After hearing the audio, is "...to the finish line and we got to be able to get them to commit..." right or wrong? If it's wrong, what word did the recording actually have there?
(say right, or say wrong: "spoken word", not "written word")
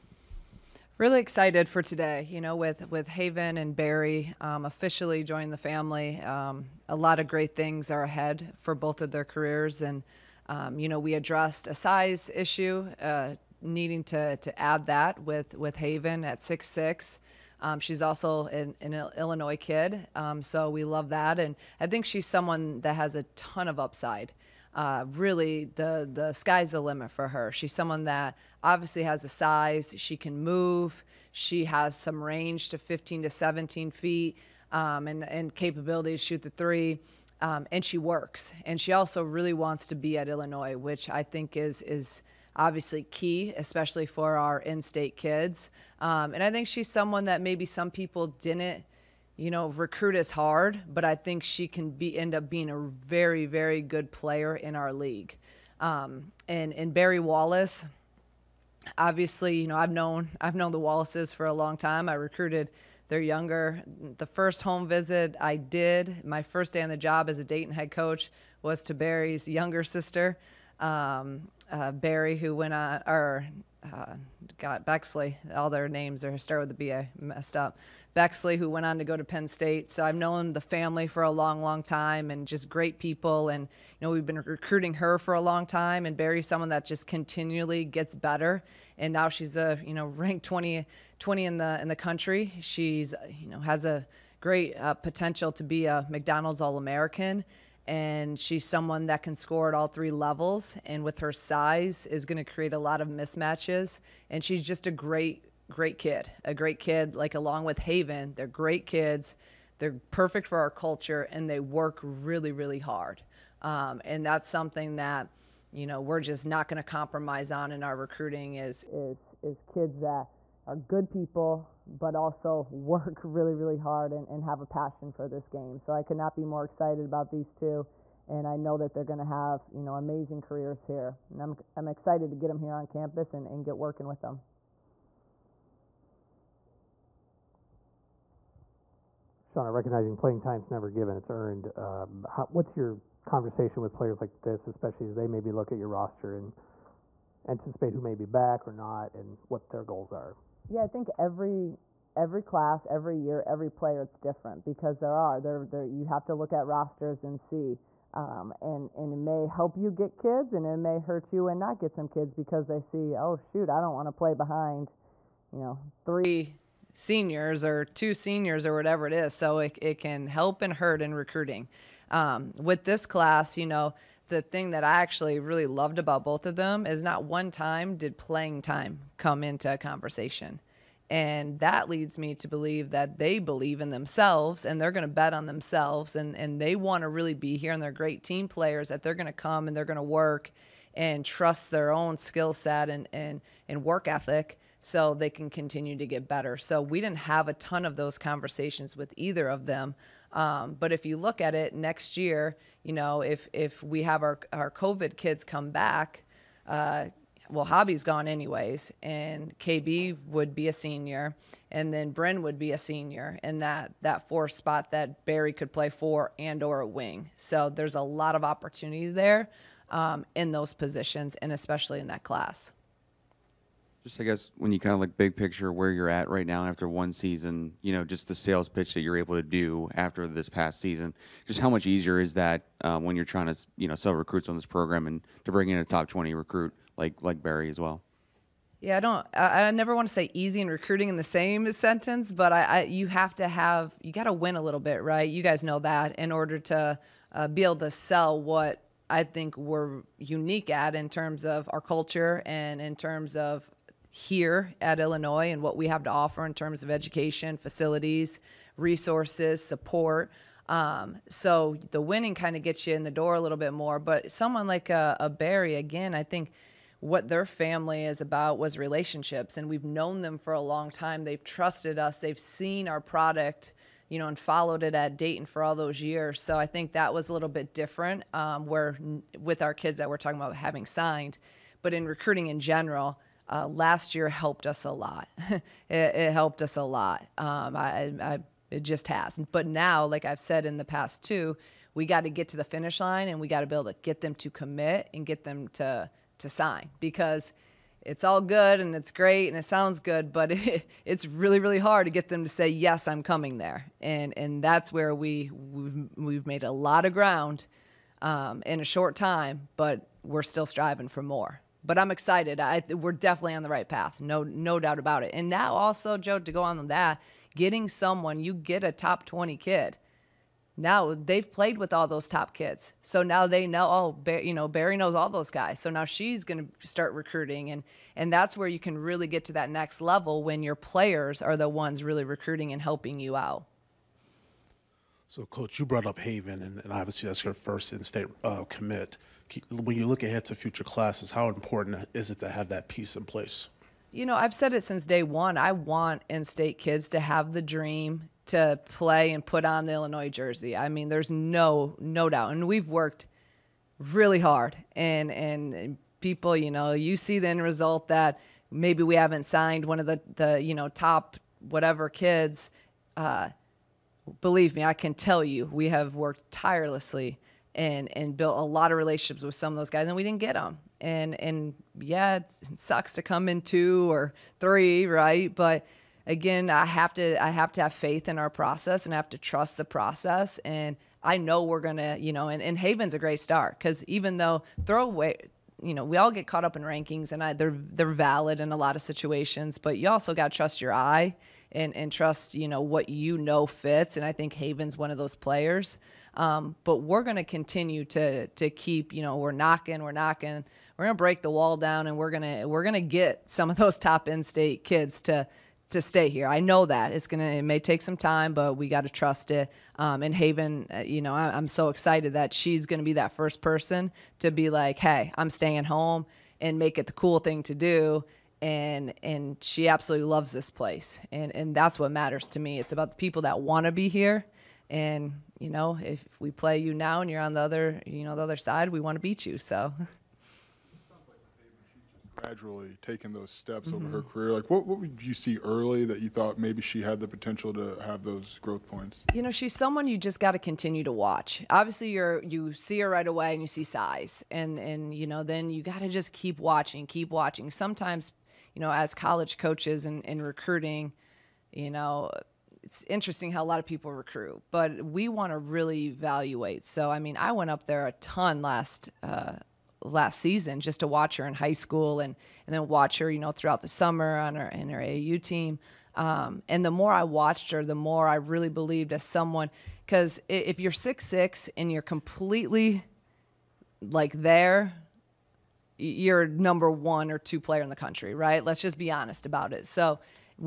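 right.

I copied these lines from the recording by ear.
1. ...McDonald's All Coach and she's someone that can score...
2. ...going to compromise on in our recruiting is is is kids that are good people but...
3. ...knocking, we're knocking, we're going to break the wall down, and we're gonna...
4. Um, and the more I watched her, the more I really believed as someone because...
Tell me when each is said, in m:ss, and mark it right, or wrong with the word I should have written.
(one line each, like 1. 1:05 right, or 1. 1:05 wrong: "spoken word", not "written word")
1. 1:36 wrong: "American", not "Coach"
2. 1:56 right
3. 6:39 right
4. 7:46 right.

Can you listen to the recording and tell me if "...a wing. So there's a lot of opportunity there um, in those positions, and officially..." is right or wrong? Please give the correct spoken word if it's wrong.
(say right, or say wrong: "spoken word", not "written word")
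wrong: "especially", not "officially".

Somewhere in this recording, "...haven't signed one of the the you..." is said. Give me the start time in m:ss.
5:59.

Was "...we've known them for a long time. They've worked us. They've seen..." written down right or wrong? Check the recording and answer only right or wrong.
wrong.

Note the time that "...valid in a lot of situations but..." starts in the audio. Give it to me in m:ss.
6:28.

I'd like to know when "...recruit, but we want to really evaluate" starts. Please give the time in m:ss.
7:34.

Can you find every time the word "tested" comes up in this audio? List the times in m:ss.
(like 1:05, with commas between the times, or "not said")
not said.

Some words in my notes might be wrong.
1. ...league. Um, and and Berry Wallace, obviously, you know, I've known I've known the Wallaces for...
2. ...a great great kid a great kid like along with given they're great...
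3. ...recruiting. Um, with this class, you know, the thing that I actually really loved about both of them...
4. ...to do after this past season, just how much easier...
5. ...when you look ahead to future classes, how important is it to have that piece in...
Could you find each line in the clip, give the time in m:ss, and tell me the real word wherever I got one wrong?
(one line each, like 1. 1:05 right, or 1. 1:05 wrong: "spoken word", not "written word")
1. 0:54 right
2. 1:44 wrong: "haven", not "given"
3. 2:51 right
4. 3:49 right
5. 5:39 right.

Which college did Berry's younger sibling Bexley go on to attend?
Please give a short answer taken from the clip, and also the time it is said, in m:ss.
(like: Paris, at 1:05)
Penn State, at 1:19.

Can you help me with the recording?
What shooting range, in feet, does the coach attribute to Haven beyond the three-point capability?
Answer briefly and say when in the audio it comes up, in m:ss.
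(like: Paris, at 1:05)
15 to 17 feet, at 0:32.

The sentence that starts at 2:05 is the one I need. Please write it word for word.
So I could not be more excited about these two.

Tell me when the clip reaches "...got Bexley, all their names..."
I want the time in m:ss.
1:14.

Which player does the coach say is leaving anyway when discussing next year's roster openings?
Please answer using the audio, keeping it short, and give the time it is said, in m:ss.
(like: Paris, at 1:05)
Hobby, at 3:27.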